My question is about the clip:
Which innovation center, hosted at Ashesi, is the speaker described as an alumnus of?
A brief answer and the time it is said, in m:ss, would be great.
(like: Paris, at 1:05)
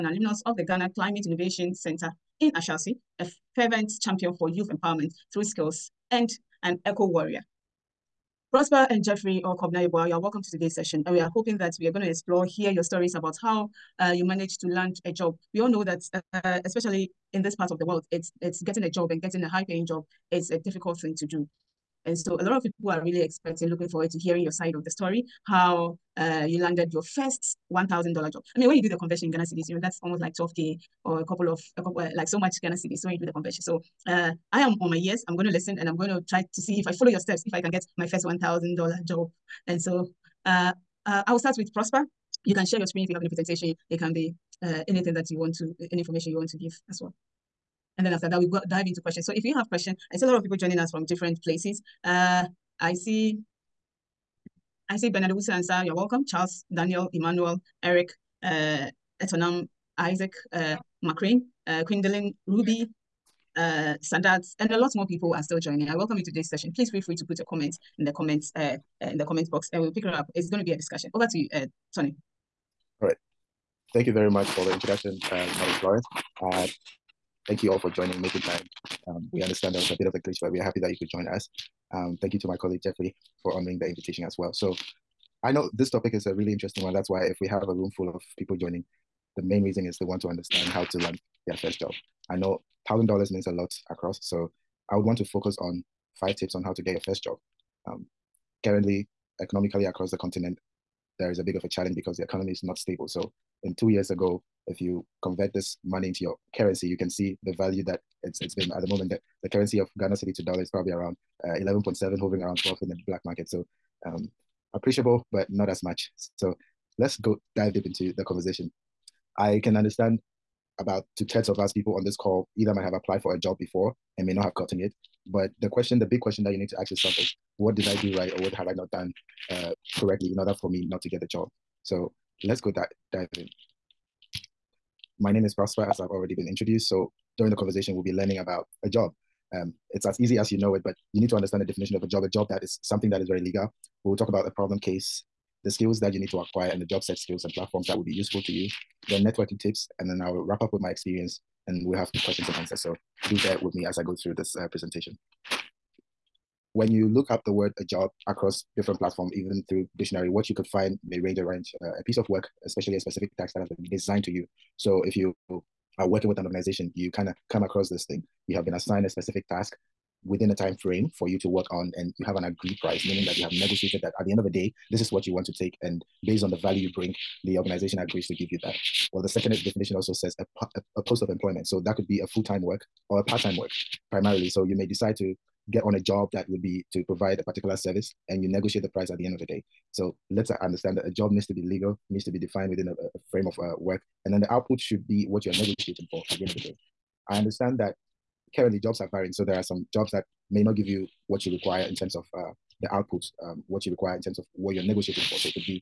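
Ghana Climate Innovation Center, at 0:00.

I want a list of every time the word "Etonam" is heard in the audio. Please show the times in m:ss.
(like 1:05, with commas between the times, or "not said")
0:59.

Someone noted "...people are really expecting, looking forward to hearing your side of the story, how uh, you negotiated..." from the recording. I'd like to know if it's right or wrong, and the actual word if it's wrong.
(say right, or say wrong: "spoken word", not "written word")
wrong: "landed", not "negotiated".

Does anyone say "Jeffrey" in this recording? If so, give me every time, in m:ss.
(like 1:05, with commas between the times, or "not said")
0:09, 1:22.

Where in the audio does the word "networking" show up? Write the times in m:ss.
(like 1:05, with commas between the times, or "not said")
2:29.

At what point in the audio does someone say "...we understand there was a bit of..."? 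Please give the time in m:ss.
1:19.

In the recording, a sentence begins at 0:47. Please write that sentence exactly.
And then after that, we go dive into questions.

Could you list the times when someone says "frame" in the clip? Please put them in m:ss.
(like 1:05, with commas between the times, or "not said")
2:50, 3:13.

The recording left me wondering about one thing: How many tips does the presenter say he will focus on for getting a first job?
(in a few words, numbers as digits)
5.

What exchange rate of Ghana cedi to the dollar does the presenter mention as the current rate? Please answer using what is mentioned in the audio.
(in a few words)
11.7.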